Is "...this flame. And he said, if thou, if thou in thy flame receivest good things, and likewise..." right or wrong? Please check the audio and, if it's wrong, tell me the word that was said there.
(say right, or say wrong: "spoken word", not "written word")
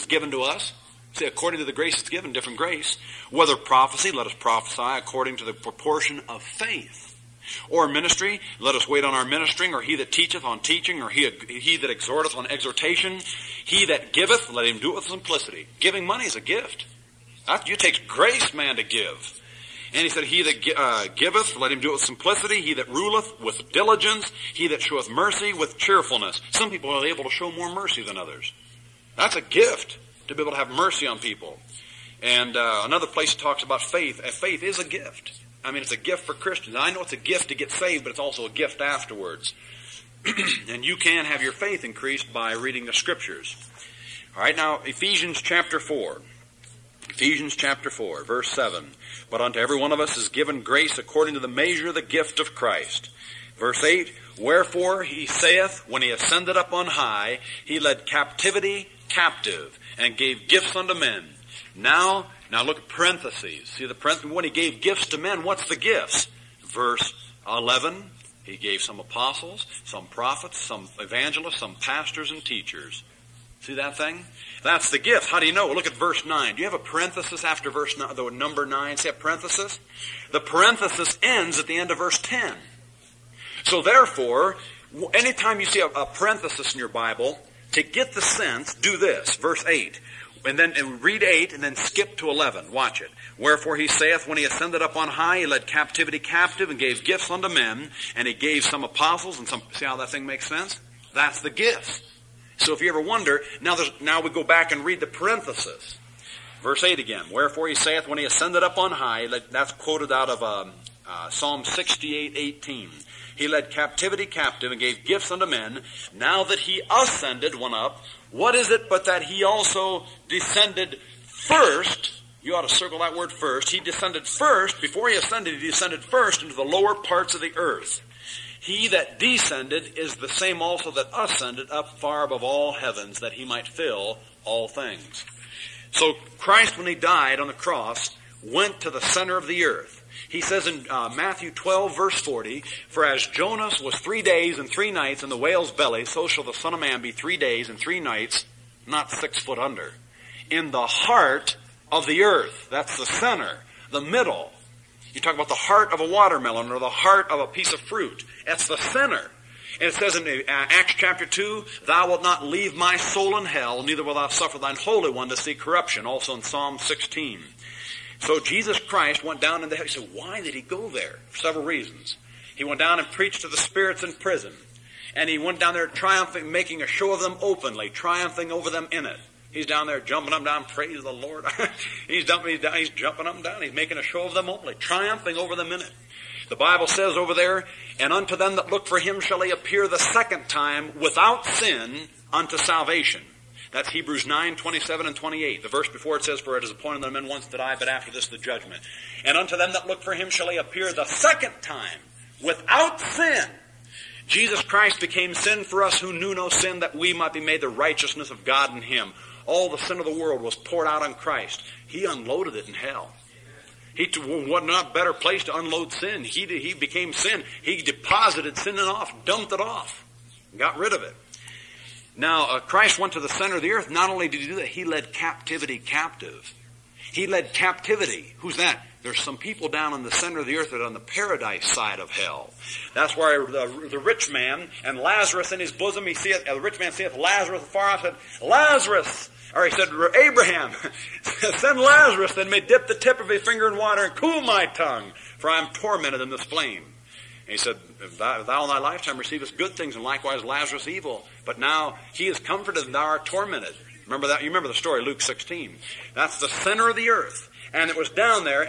wrong: "lifetime", not "flame".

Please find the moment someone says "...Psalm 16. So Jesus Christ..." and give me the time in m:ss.
2:46.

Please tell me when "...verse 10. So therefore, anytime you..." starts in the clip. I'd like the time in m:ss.
1:21.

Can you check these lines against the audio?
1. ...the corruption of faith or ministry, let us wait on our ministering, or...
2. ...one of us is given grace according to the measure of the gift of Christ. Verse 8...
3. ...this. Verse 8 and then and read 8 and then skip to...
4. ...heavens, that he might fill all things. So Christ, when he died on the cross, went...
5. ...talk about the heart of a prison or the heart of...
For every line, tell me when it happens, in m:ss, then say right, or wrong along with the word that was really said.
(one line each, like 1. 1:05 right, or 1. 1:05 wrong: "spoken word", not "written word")
1. 0:05 wrong: "proportion", not "corruption"
2. 0:49 right
3. 1:28 right
4. 2:12 right
5. 2:35 wrong: "watermelon", not "prison".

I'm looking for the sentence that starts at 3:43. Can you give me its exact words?
Not only did he do that, he led captivity captive.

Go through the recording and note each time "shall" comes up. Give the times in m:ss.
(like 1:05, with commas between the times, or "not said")
2:26, 3:09, 3:20.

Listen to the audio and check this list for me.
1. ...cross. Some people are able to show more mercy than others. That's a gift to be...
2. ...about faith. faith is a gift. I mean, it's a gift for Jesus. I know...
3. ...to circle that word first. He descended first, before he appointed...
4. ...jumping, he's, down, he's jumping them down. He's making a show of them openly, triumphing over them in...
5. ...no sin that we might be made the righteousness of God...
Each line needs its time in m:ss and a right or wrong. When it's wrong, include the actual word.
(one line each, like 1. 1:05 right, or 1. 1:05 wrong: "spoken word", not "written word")
1. 0:25 wrong: "cheerfulness", not "cross"
2. 0:33 wrong: "Christians", not "Jesus"
3. 2:02 wrong: "ascended", not "appointed"
4. 3:02 right
5. 3:26 right.